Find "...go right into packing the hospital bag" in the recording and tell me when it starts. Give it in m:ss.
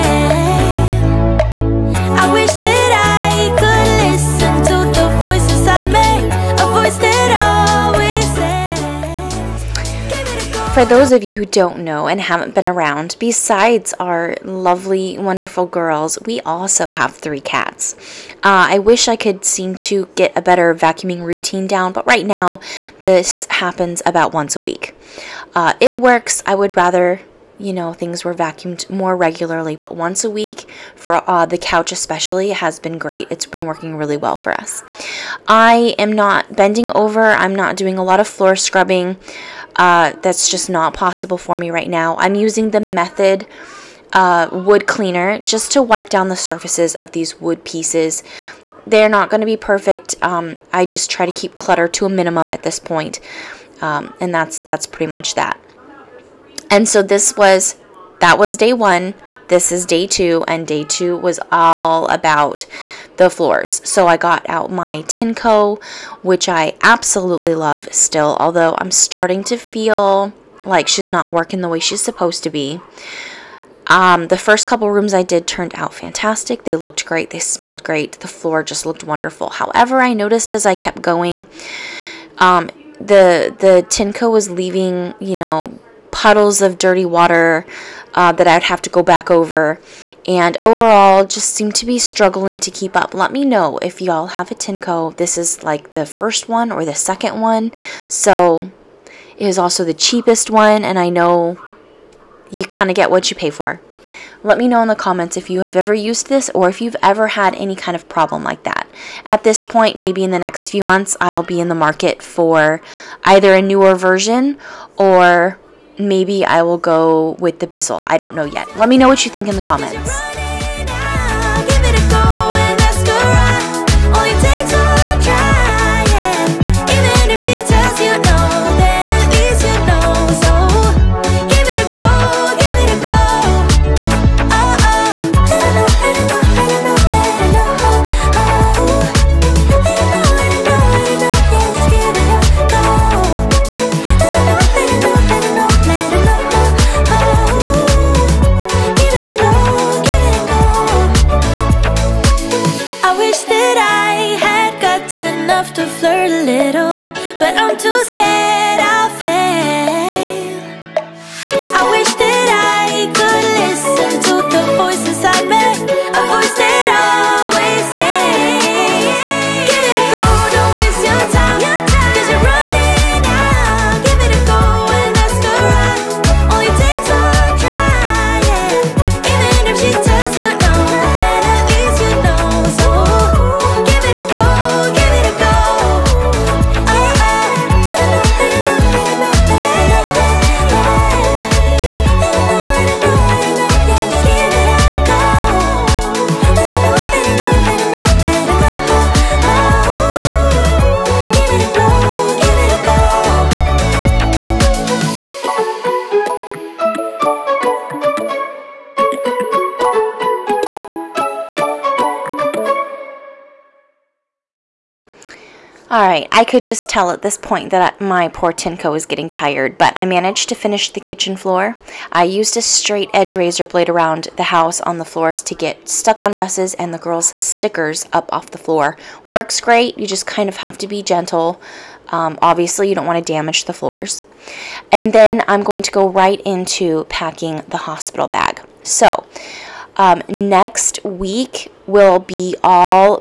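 3:55.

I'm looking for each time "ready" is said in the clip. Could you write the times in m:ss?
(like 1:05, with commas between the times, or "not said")
not said.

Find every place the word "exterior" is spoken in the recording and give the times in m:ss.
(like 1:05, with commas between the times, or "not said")
not said.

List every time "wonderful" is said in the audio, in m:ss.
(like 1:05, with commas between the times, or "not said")
0:15, 1:19.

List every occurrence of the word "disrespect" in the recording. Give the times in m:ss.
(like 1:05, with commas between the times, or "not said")
not said.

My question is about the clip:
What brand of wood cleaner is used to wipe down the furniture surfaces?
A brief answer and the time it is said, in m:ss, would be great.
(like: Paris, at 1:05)
Method, at 0:42.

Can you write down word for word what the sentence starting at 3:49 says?
Works great, you just kind of have to be gentle.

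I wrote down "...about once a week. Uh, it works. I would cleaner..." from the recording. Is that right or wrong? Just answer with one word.
wrong.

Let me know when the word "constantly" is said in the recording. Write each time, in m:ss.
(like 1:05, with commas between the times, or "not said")
not said.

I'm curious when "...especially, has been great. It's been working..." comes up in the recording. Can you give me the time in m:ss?
0:31.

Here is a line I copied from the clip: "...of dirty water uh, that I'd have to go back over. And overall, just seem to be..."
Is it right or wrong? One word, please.
right.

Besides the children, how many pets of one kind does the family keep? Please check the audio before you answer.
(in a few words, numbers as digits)
3.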